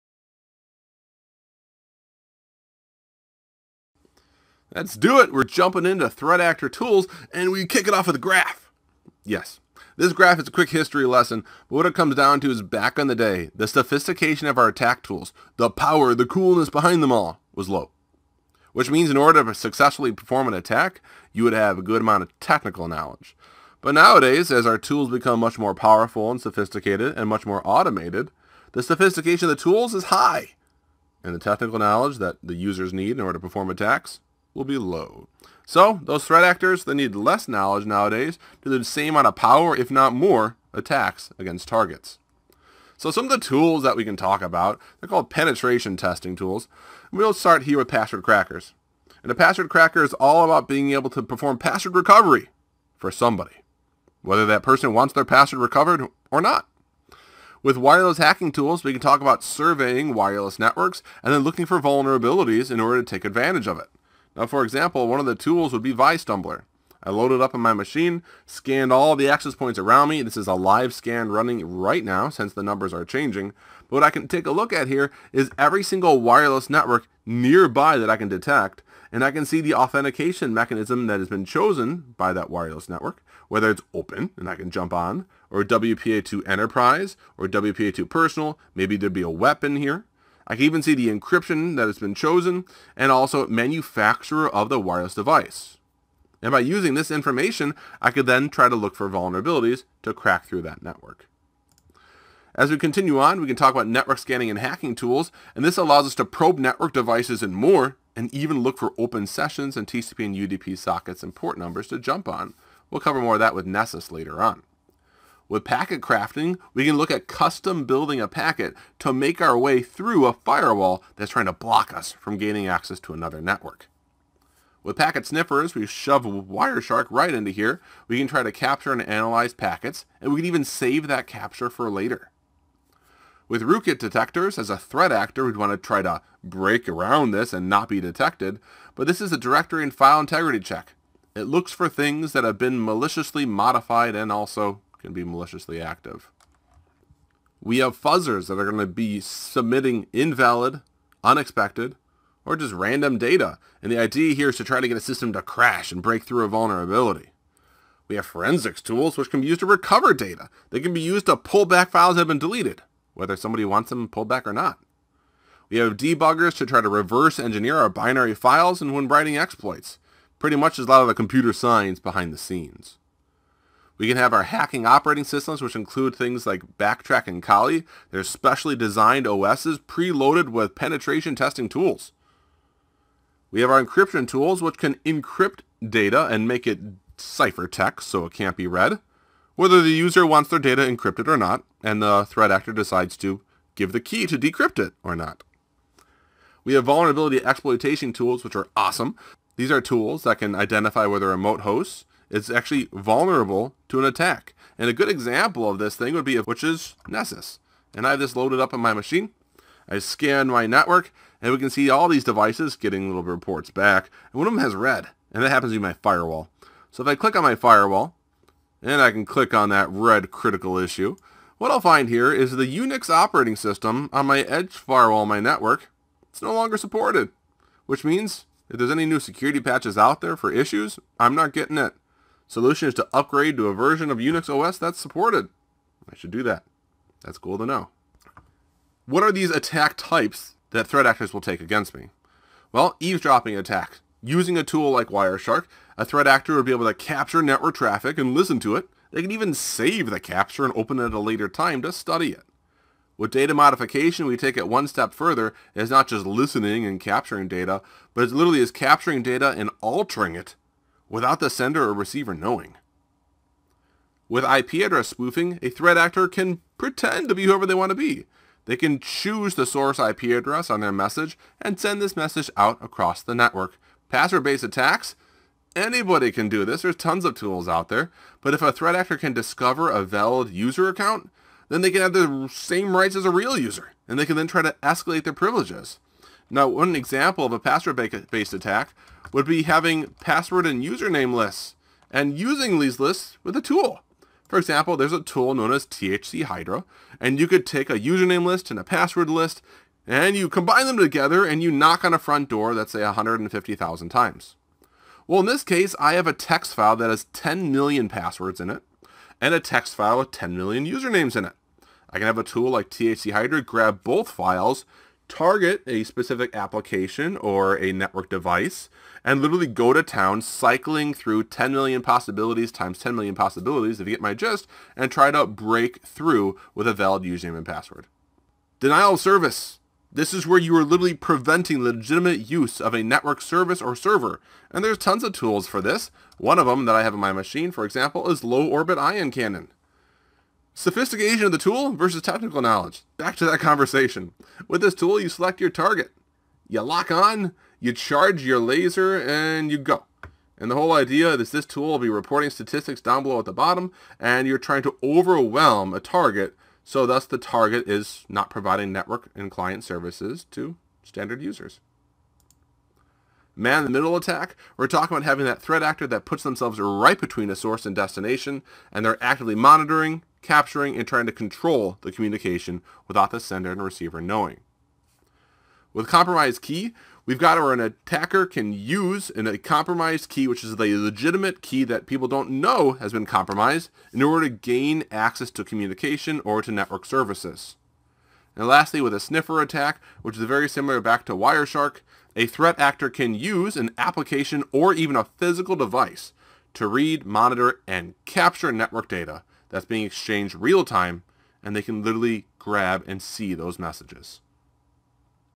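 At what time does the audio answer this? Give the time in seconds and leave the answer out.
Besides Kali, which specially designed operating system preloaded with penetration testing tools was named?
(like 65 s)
176 s.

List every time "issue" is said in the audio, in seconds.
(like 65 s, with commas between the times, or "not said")
220 s, 230 s.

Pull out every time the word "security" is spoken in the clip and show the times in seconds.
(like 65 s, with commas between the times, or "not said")
229 s.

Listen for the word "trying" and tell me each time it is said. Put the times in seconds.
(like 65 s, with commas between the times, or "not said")
121 s, 354 s, 371 s.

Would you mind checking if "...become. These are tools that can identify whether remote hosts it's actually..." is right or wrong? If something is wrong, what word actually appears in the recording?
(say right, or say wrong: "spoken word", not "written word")
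wrong: "awesome", not "become".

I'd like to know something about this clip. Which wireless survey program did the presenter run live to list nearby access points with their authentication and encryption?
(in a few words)
Vistumbler.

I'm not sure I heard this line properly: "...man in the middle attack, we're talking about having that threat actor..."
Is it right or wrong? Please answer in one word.
right.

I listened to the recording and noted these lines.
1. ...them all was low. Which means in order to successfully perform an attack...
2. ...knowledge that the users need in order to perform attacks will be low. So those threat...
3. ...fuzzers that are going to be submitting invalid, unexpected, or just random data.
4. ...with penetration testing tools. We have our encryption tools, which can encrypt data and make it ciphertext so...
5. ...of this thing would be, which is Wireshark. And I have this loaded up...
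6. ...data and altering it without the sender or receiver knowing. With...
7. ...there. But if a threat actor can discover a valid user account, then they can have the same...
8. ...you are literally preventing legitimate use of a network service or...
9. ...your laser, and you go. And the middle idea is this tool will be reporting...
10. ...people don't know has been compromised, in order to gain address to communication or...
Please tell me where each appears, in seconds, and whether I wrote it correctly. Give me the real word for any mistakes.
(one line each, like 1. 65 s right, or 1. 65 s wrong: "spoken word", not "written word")
1. 17 s right
2. 31 s right
3. 147 s right
4. 180 s right
5. 205 s wrong: "Nessus", not "Wireshark"
6. 259 s right
7. 277 s right
8. 330 s right
9. 348 s wrong: "whole", not "middle"
10. 382 s wrong: "access", not "address".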